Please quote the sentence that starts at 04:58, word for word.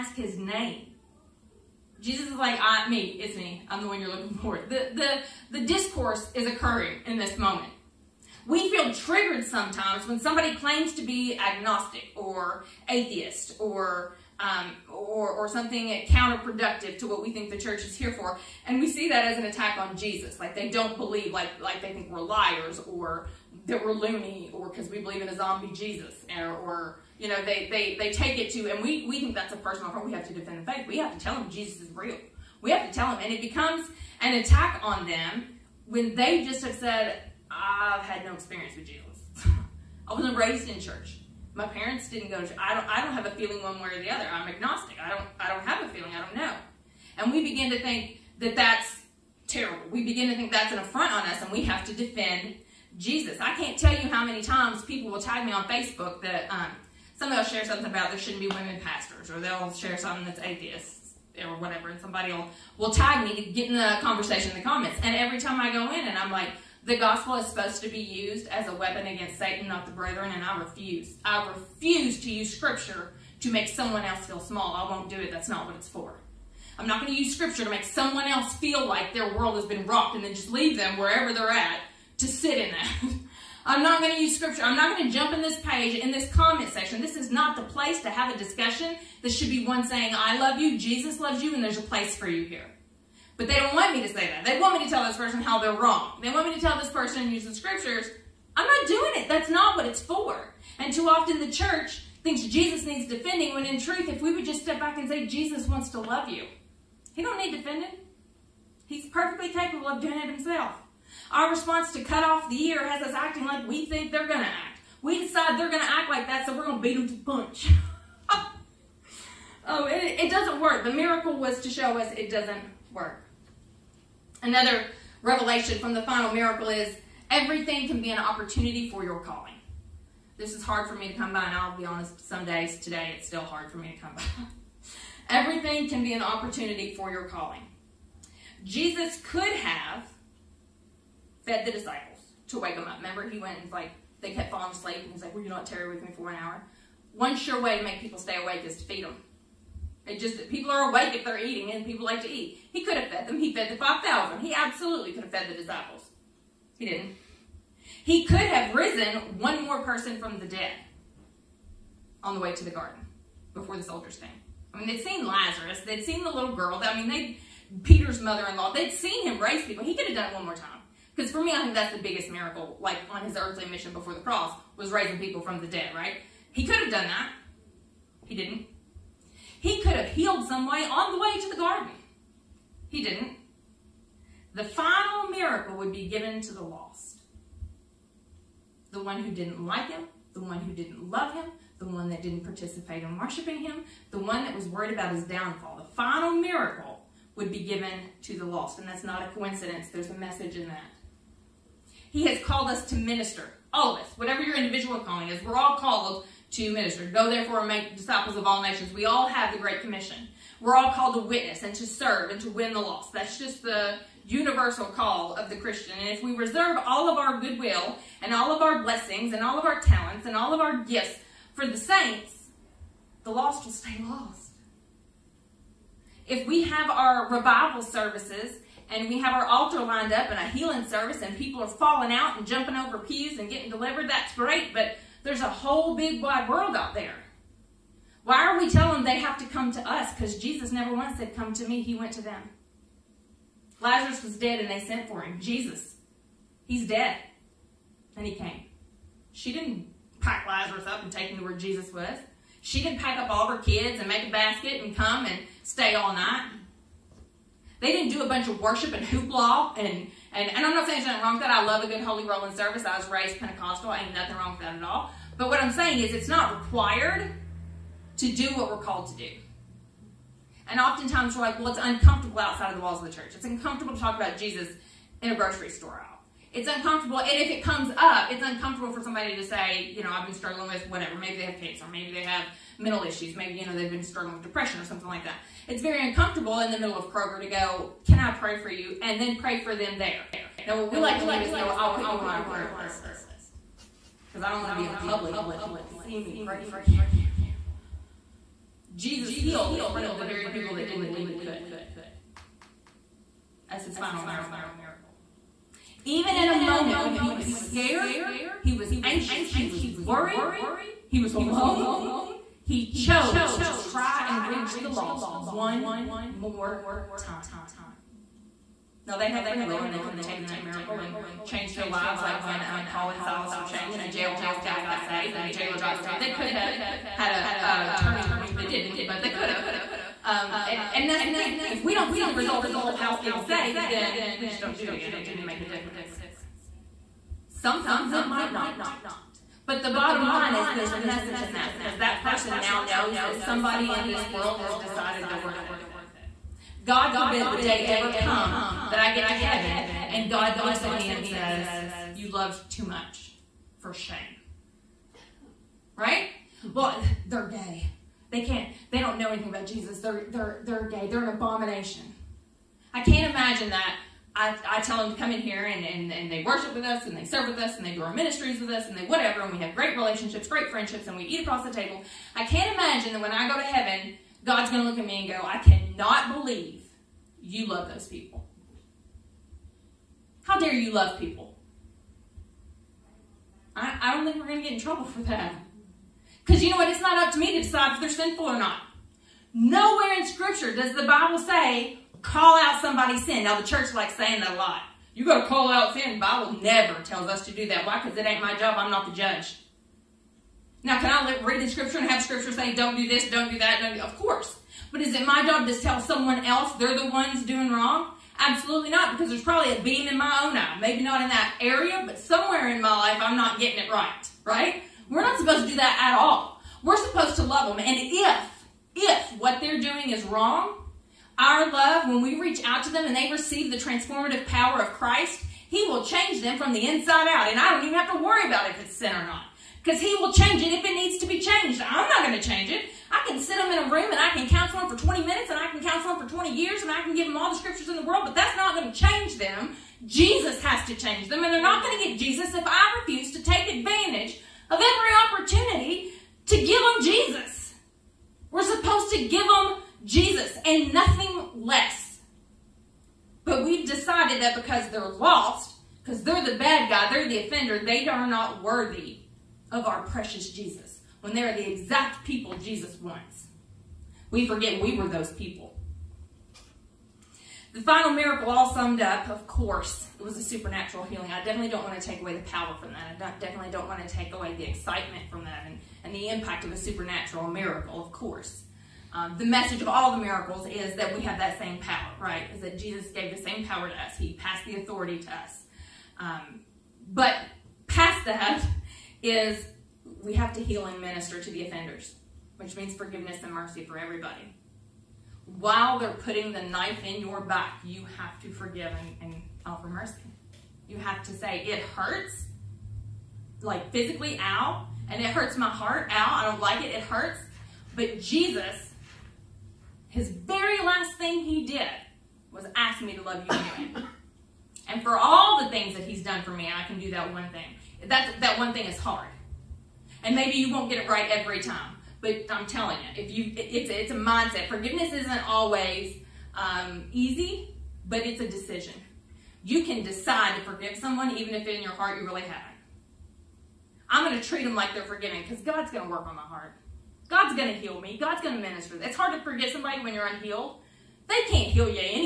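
Jesus healed in front of the very people that didn't believe he could.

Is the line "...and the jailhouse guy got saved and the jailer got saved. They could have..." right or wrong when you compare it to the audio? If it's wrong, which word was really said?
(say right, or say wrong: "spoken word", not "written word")
right.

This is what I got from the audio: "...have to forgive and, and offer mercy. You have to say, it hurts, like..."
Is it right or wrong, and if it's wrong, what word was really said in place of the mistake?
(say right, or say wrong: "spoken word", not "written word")
right.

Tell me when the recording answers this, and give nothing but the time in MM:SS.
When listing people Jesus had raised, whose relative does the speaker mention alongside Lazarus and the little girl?
02:47.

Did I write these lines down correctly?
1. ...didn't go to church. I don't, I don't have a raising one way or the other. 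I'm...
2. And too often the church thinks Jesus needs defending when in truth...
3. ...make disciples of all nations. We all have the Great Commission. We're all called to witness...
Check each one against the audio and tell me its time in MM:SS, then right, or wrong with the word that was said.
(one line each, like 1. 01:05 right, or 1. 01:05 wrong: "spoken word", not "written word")
1. 00:42 wrong: "feeling", not "raising"
2. 01:40 right
3. 03:27 right.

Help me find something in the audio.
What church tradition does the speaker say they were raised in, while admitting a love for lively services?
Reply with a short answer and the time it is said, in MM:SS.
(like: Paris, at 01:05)
Pentecostal, at 04:23.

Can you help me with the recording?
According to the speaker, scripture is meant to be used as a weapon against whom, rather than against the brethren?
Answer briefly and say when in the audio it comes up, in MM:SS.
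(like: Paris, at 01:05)
Satan, at 01:09.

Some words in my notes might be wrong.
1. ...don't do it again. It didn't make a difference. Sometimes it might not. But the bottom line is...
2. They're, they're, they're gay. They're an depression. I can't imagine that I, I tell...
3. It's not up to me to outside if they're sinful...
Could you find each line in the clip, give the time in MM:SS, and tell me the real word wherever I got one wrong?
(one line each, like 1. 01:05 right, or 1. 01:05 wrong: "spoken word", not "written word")
1. 05:34 right
2. 05:59 wrong: "abomination", not "depression"
3. 06:26 wrong: "decide", not "outside".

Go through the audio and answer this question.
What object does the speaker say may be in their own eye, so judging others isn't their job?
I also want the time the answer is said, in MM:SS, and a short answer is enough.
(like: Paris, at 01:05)
a beam, at 06:49.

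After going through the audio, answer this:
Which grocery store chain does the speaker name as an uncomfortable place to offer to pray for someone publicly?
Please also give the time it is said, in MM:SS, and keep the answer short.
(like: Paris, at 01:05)
Kroger, at 04:47.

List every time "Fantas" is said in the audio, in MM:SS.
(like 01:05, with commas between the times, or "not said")
not said.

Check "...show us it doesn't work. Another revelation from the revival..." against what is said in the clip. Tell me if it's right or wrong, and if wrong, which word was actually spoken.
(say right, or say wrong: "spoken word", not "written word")
wrong: "final", not "revival".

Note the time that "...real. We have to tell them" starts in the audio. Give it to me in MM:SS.
00:31.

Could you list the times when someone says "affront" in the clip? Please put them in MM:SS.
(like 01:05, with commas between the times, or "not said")
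00:29, 00:50.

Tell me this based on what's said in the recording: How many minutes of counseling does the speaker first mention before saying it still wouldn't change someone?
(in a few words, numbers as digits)
20.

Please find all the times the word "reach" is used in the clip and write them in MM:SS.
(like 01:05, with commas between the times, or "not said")
05:14, 07:02.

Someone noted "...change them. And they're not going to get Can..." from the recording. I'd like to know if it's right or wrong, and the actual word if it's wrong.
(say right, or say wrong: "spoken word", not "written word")
wrong: "Jesus", not "Can".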